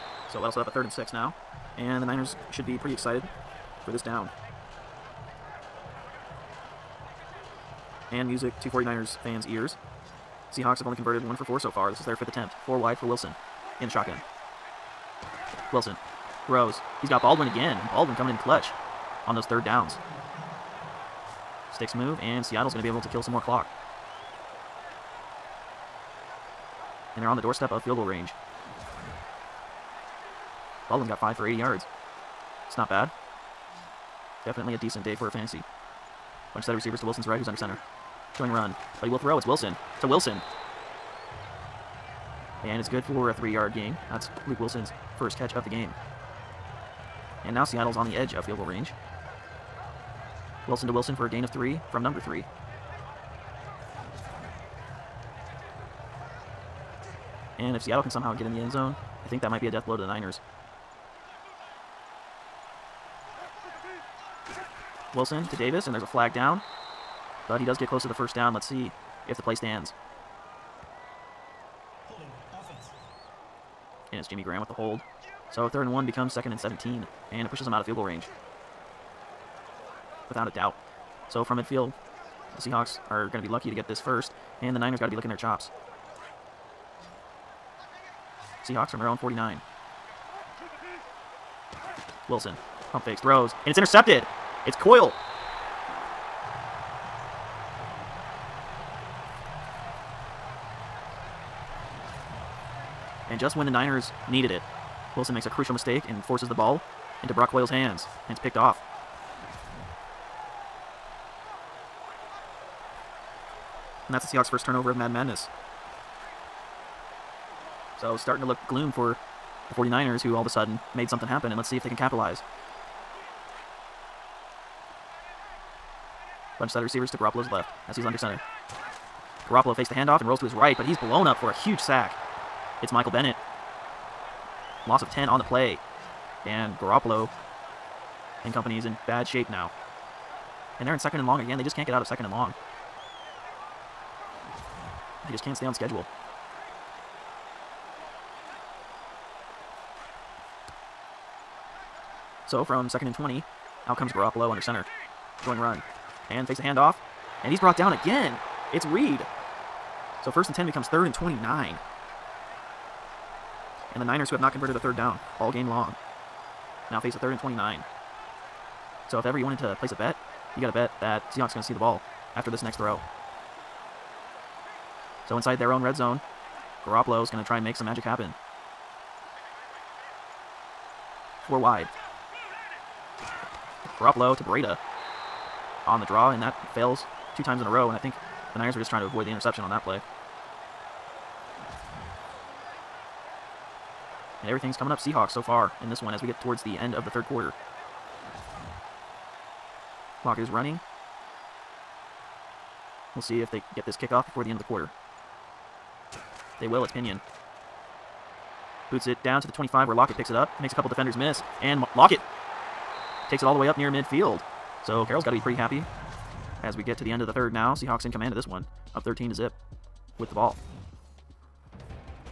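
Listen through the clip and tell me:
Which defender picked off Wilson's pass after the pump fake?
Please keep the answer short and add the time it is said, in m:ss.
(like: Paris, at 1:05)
Brock Coyle, at 1:47.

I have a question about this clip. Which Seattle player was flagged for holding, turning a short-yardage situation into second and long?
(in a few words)
Jimmy Graham.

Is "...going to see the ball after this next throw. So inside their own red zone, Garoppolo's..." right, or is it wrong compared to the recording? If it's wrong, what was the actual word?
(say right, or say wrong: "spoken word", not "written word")
right.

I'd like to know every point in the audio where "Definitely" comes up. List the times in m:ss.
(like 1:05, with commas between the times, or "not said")
0:34.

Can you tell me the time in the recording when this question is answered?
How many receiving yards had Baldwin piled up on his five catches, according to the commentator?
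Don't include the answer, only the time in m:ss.
0:31.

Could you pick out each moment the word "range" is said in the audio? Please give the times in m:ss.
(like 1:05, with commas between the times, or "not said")
0:28, 0:48, 1:18.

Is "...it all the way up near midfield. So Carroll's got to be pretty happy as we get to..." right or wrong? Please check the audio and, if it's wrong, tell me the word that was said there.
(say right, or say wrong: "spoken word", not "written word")
right.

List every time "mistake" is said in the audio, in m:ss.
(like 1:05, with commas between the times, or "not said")
1:45.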